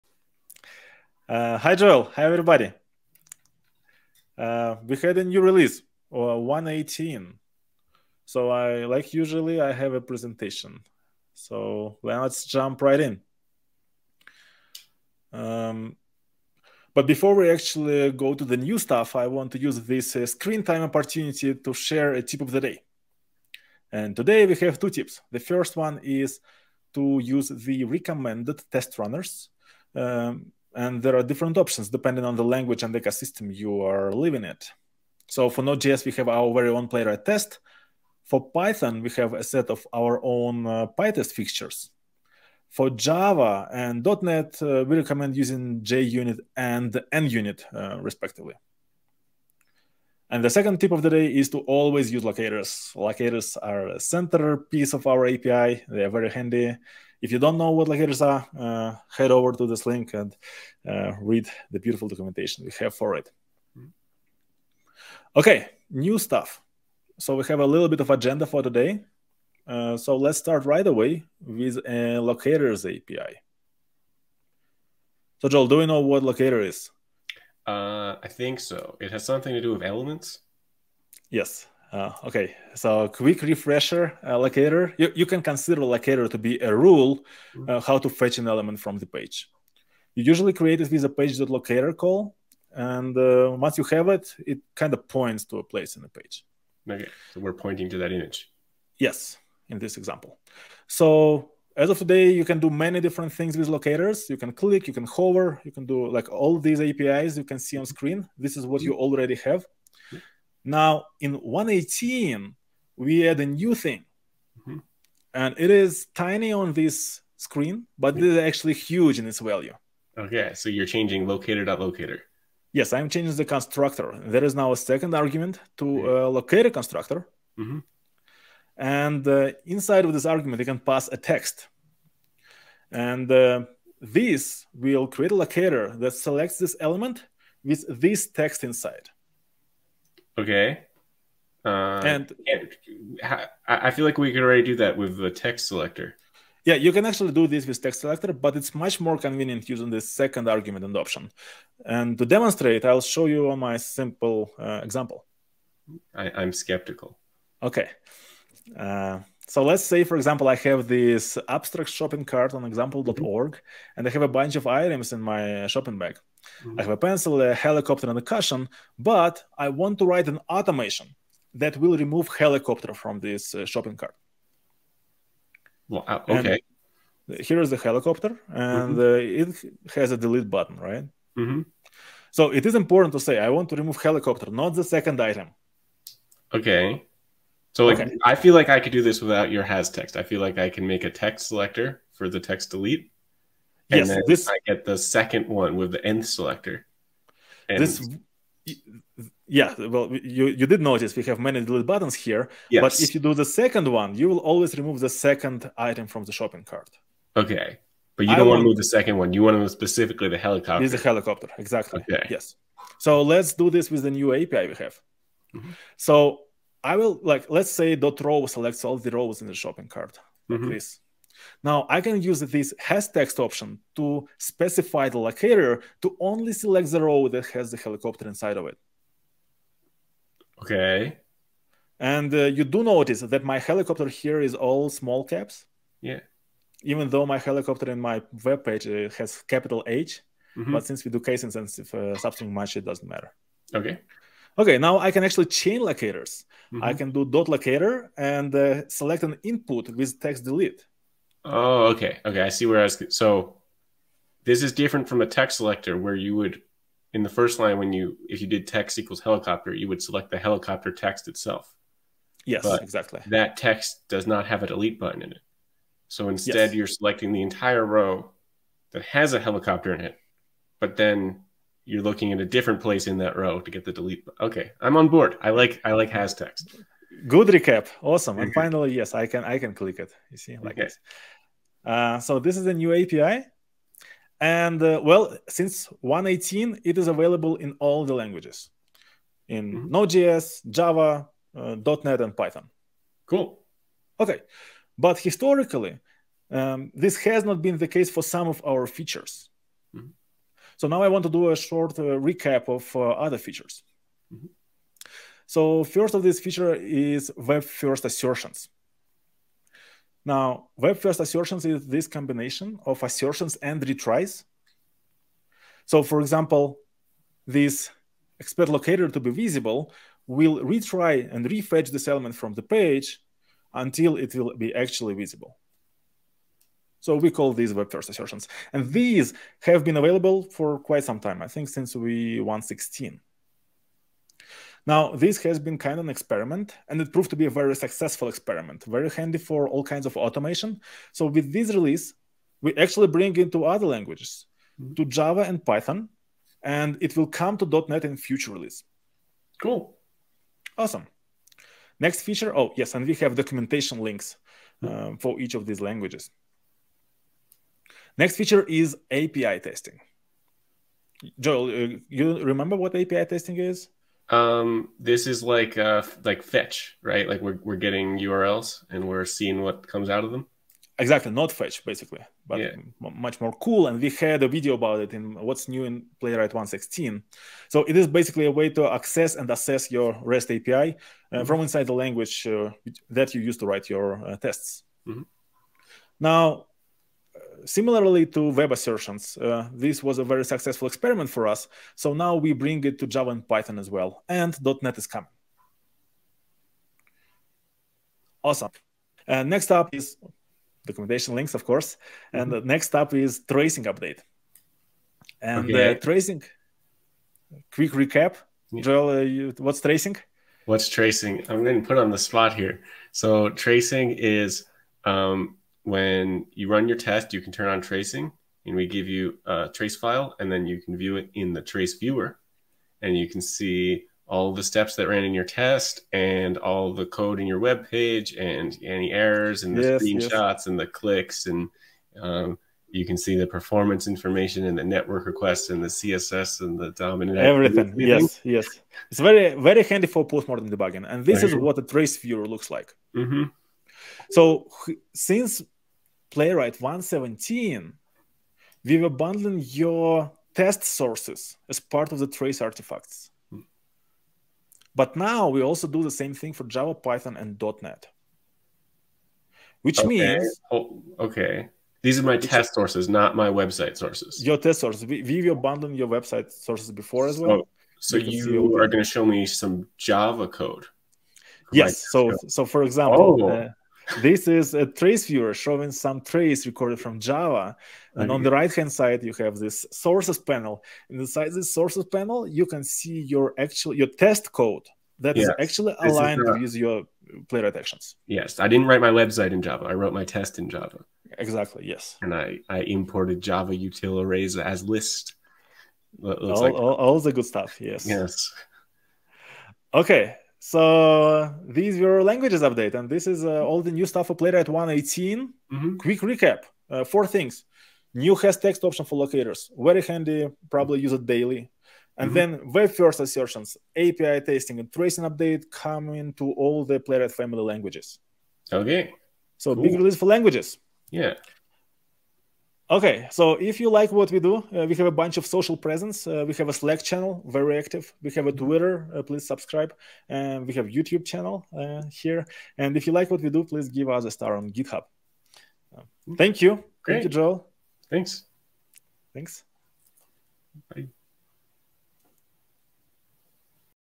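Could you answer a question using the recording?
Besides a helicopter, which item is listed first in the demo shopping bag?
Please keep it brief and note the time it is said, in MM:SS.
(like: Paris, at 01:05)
pencil, at 02:46.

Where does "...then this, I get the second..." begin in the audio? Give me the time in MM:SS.
03:14.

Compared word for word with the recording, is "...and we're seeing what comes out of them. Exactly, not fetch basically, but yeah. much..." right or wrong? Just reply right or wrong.
right.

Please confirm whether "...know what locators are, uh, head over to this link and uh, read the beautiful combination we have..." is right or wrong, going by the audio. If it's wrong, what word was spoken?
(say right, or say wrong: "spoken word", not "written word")
wrong: "documentation", not "combination".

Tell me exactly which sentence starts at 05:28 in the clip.
And these have been available for quite some time, I think since we 116.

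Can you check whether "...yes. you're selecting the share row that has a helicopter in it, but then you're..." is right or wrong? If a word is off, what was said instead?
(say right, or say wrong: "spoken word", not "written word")
wrong: "entire", not "share".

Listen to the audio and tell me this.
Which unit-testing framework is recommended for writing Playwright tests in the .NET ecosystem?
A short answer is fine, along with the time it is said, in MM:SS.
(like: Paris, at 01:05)
NUnit, at 00:47.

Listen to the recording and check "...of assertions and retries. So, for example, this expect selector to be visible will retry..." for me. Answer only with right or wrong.
wrong.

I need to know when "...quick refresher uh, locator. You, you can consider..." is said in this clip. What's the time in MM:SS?
01:23.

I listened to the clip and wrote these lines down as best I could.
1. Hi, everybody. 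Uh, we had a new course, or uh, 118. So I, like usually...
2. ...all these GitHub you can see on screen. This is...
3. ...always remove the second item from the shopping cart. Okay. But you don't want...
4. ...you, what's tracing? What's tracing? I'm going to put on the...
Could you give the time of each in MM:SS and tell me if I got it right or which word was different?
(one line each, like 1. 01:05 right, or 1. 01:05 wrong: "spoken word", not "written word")
1. 00:02 wrong: "release", not "course"
2. 01:46 wrong: "APIs", not "GitHub"
3. 03:24 right
4. 06:49 right.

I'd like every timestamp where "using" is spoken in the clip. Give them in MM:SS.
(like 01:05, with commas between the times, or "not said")
00:45, 02:29.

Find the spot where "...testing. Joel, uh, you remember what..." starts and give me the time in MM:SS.
05:59.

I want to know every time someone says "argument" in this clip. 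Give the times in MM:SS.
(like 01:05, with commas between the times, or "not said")
02:05, 02:10, 02:30.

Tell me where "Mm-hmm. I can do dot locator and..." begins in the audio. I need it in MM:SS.
04:06.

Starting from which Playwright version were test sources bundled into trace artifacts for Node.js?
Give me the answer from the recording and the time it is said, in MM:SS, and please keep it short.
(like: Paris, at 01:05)
1.17, at 07:26.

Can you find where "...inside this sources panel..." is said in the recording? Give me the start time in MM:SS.
08:01.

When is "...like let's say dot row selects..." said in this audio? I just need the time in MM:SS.
03:37.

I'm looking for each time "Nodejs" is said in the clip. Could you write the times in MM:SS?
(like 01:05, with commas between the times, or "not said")
00:35, 04:49.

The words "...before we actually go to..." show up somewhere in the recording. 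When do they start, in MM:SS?
00:17.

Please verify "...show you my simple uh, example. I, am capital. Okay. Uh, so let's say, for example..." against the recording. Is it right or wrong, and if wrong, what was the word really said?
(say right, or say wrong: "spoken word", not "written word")
wrong: "skeptical", not "capital".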